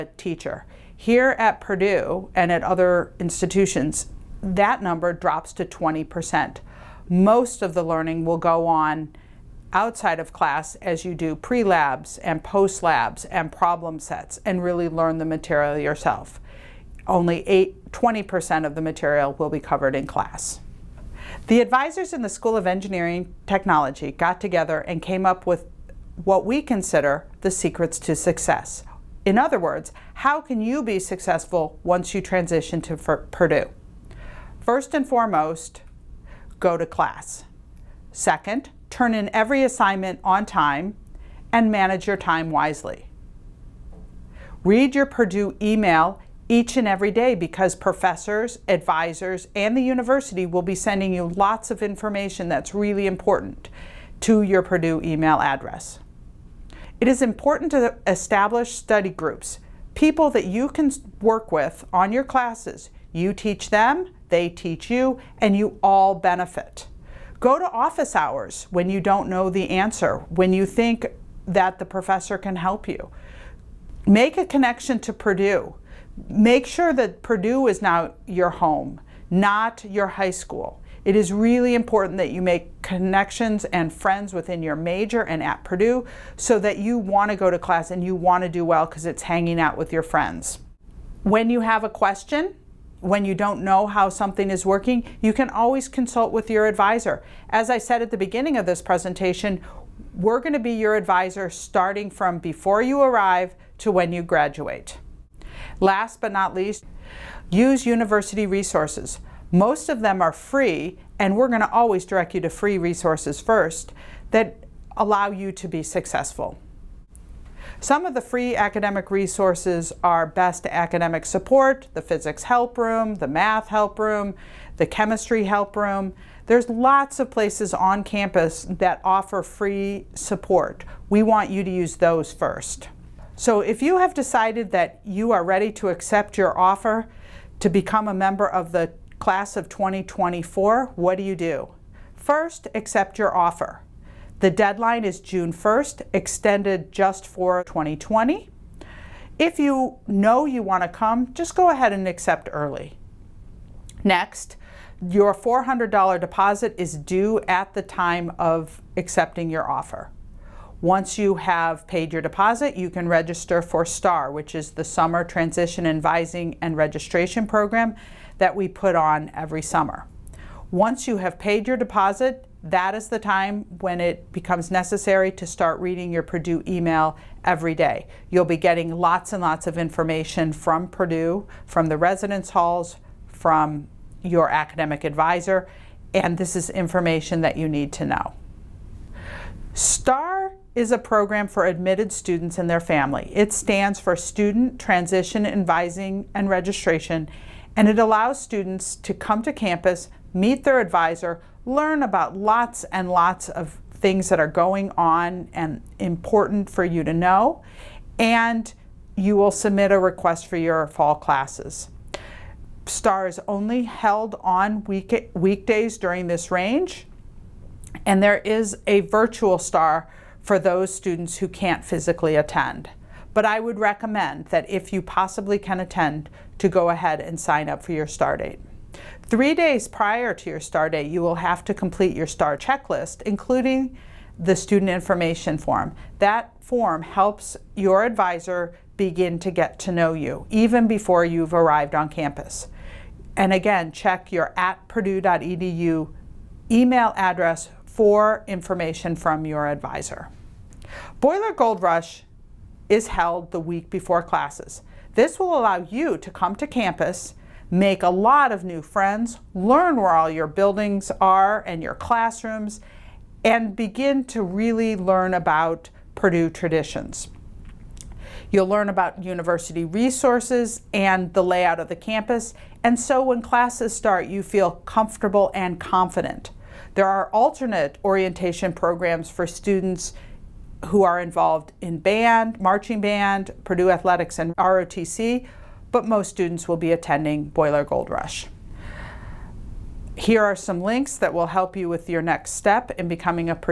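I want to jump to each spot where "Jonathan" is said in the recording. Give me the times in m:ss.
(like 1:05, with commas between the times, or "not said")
not said.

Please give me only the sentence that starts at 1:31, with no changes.
When you have a question, when you don't know how something is working, you can always consult with your advisor.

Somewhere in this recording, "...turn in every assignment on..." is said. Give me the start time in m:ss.
0:38.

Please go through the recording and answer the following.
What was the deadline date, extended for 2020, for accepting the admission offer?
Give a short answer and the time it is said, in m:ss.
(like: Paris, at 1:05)
June 1st, at 2:25.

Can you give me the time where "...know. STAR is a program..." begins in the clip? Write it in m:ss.
3:08.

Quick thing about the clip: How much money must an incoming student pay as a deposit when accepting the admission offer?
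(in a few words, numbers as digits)
$400.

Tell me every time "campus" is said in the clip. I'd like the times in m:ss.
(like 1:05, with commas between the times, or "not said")
2:08, 3:19, 4:02, 4:16, 4:31.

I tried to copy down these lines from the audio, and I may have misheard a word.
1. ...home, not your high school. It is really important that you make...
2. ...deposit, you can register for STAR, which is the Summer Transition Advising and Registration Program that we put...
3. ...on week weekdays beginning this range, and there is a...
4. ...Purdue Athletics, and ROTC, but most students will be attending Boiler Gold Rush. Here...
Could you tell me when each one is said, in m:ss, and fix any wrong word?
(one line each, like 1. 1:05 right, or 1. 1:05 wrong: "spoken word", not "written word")
1. 1:18 right
2. 2:42 right
3. 3:34 wrong: "during", not "beginning"
4. 4:43 right.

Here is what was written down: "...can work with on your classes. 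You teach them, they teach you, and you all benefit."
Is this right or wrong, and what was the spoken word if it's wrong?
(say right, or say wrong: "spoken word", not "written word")
right.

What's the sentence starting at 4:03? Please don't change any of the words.
And again, check your at purdue.edu email address for information from your advisor.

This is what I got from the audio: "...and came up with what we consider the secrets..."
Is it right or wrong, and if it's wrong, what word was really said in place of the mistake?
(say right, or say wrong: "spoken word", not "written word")
right.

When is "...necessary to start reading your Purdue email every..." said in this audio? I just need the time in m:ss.
2:54.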